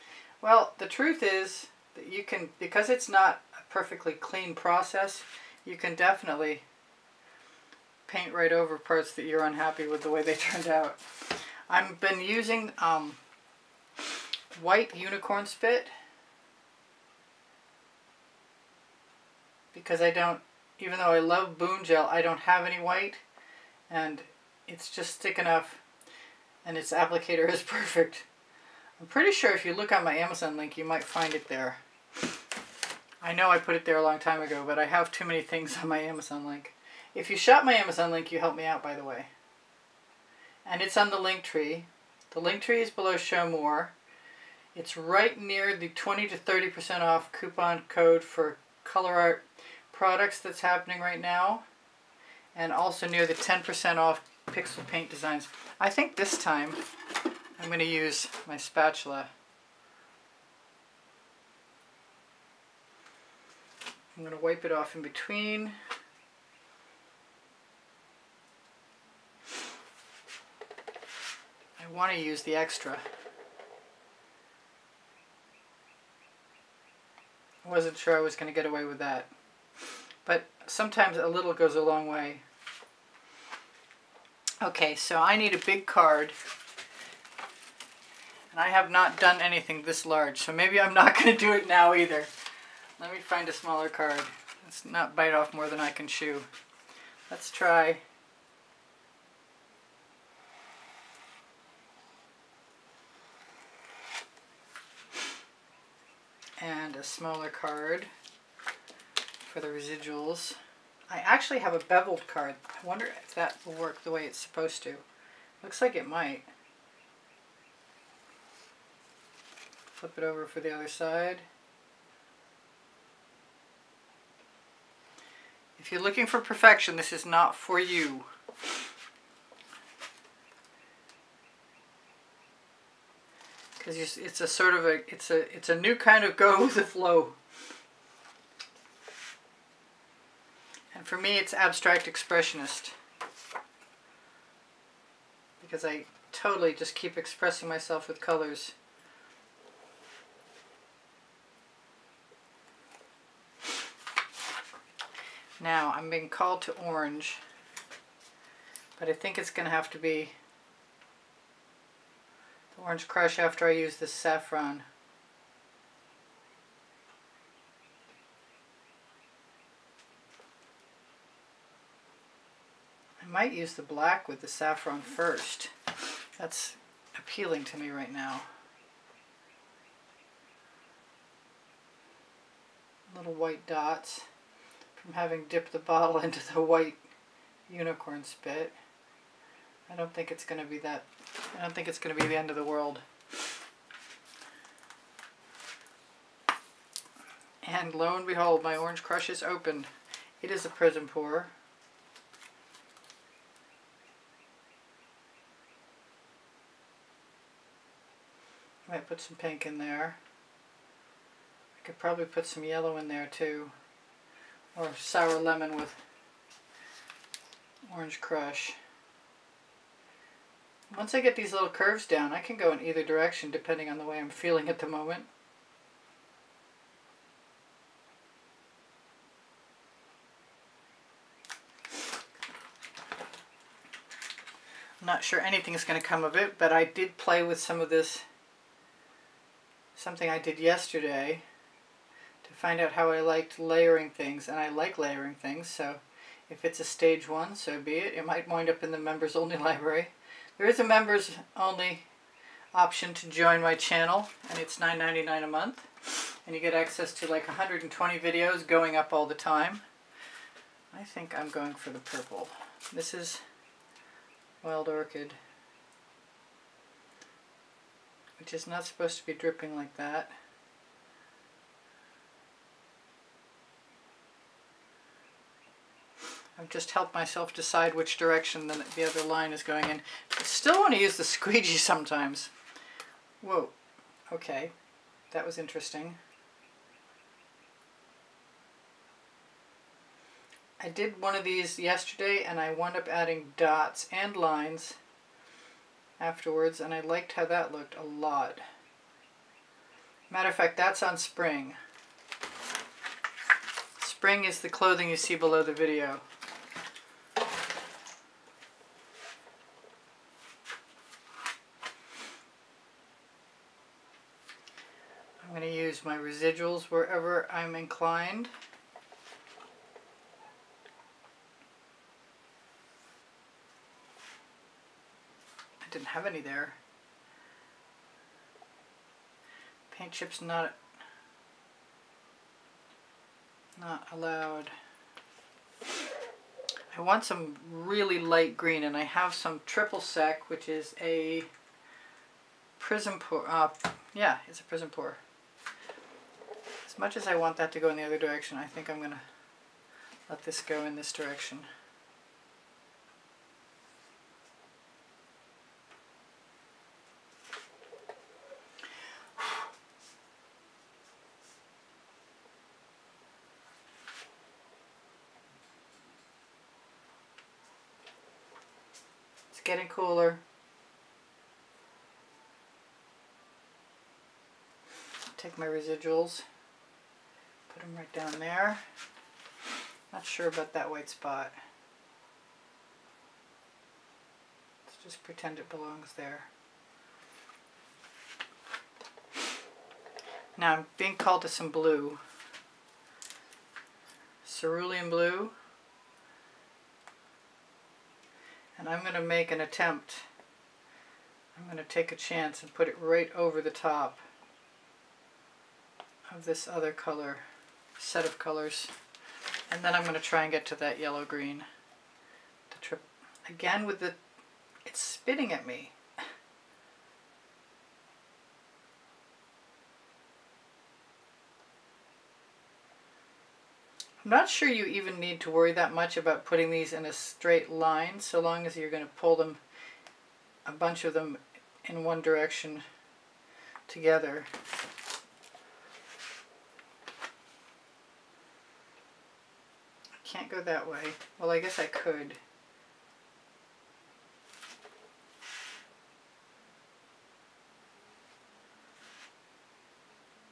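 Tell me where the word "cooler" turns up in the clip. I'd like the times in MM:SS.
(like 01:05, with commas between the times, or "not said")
06:09.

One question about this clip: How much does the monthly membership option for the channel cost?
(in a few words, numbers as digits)
$9.99.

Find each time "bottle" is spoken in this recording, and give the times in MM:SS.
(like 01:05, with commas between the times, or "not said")
03:05.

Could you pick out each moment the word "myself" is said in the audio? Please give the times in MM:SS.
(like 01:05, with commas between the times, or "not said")
02:27, 04:37.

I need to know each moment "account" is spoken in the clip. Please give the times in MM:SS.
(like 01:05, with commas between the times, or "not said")
not said.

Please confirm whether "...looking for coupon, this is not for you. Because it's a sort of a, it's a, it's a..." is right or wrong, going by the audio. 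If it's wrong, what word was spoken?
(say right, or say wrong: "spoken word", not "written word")
wrong: "perfection", not "coupon".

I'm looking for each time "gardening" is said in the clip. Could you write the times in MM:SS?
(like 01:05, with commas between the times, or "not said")
not said.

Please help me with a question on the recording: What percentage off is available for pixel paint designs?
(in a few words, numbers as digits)
10%.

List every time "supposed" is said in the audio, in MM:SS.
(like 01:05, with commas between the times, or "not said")
01:54, 04:28.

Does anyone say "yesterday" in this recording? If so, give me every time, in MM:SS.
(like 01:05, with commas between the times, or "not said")
04:00, 04:51.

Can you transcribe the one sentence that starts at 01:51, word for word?
I actually have a beveled card.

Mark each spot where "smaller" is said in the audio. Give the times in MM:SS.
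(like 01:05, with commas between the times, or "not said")
01:33, 01:47.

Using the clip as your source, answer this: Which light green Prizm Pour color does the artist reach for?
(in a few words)
triple sec.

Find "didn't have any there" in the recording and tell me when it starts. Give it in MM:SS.
05:25.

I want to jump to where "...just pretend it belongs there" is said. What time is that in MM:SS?
06:25.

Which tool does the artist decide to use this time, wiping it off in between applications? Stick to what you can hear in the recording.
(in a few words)
spatula.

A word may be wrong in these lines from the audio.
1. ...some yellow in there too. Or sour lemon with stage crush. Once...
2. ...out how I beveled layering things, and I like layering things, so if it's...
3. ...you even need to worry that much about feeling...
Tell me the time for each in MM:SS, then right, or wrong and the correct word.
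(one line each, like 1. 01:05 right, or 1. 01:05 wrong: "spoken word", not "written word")
1. 03:32 wrong: "orange", not "stage"
2. 04:02 wrong: "liked", not "beveled"
3. 07:04 wrong: "putting", not "feeling".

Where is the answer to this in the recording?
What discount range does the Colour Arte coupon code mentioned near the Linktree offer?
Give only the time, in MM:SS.
00:45.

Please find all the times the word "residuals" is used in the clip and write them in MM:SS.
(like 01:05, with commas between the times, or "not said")
01:49, 05:16, 06:15.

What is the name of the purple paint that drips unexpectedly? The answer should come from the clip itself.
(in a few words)
Wild Orchid.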